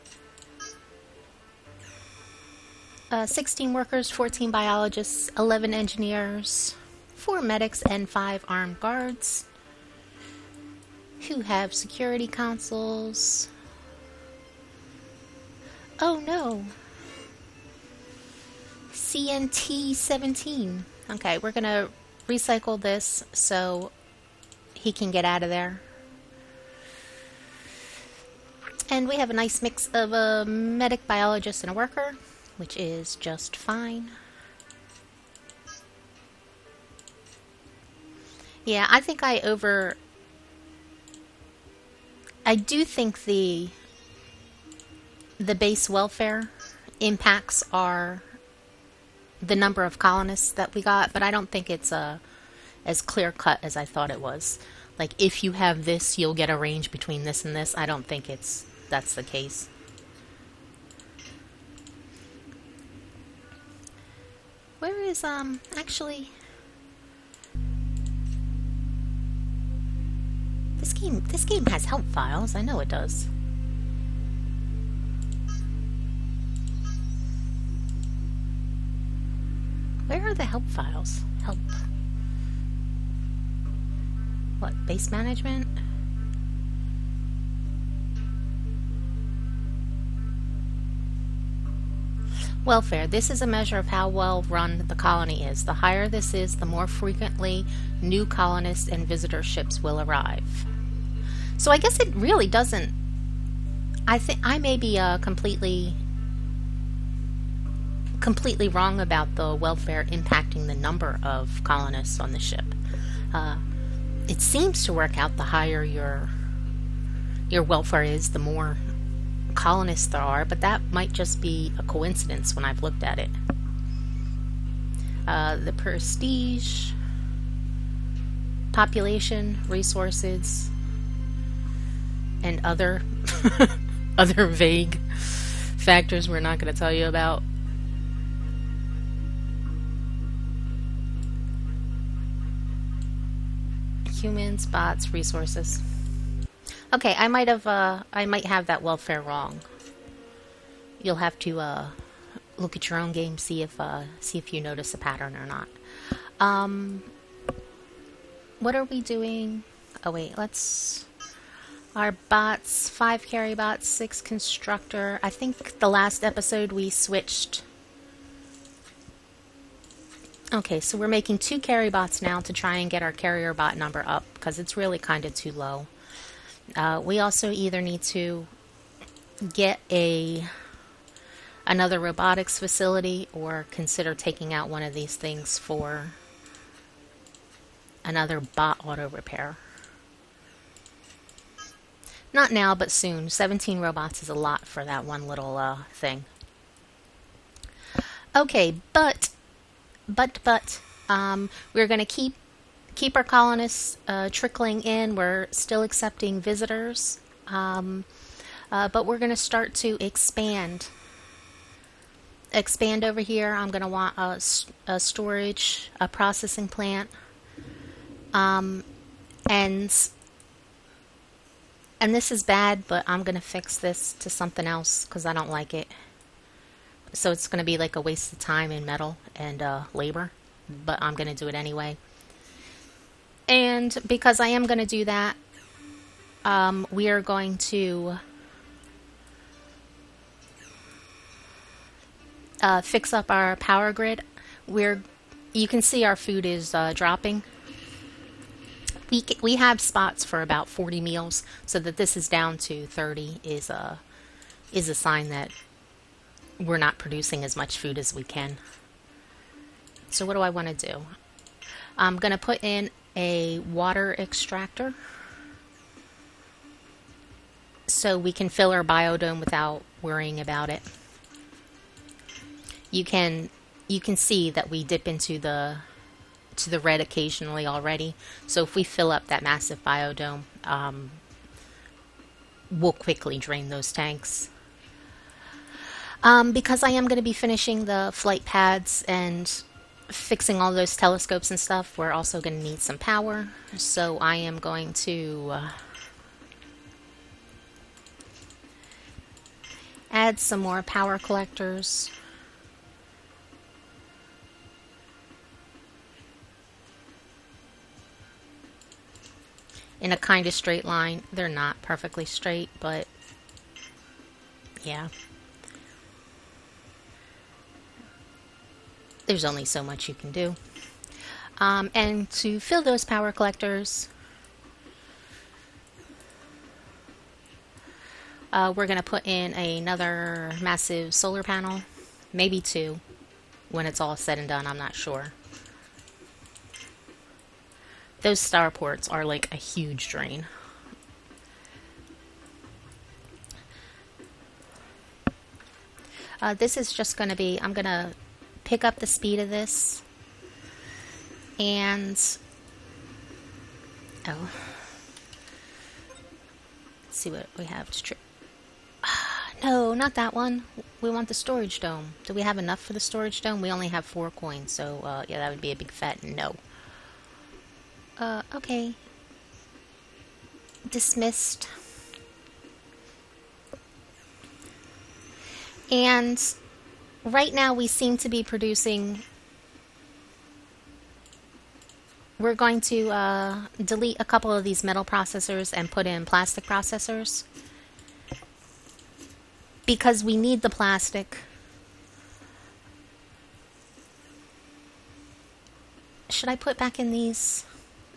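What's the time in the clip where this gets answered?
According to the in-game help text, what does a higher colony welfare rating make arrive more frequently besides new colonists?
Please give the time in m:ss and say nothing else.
1:39.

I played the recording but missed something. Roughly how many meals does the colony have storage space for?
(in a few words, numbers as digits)
40.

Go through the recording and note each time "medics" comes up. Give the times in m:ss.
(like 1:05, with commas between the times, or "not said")
0:07, 0:30.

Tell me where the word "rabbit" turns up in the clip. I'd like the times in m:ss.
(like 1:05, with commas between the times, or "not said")
not said.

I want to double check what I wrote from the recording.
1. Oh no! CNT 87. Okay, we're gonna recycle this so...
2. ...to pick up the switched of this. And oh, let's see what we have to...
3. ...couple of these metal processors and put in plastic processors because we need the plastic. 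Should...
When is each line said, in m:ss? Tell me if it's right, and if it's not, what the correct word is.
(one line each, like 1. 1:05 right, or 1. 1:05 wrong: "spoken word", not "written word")
1. 0:16 wrong: "17", not "87"
2. 5:47 wrong: "speed", not "switched"
3. 6:24 right.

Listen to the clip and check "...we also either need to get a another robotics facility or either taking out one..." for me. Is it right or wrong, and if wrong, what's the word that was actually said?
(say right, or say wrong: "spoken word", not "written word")
wrong: "consider", not "either".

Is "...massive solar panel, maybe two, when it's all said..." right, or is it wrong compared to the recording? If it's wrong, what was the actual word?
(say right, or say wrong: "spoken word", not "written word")
right.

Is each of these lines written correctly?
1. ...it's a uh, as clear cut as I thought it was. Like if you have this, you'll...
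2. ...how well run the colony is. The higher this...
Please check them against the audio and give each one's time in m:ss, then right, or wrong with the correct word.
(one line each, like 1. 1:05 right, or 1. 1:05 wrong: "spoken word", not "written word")
1. 0:51 right
2. 1:33 right.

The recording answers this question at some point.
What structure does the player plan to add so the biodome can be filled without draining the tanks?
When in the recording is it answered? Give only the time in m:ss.
4:23.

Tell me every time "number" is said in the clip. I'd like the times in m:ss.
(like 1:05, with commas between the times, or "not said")
0:49, 1:50, 2:53.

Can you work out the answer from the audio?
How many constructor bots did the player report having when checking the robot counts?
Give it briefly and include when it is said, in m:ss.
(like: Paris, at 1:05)
6, at 2:43.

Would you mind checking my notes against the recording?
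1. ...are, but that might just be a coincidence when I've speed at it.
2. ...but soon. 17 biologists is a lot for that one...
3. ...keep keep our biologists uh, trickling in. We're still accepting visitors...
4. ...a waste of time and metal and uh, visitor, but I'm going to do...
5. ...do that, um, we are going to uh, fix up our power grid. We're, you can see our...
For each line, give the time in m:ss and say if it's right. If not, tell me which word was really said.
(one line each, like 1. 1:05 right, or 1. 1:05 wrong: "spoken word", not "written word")
1. 2:00 wrong: "looked", not "speed"
2. 3:12 wrong: "robots", not "biologists"
3. 3:22 wrong: "colonists", not "biologists"
4. 3:47 wrong: "labor", not "visitor"
5. 3:54 right.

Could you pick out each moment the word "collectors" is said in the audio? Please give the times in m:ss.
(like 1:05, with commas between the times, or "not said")
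5:01, 5:23.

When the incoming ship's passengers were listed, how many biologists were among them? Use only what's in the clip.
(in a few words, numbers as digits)
14.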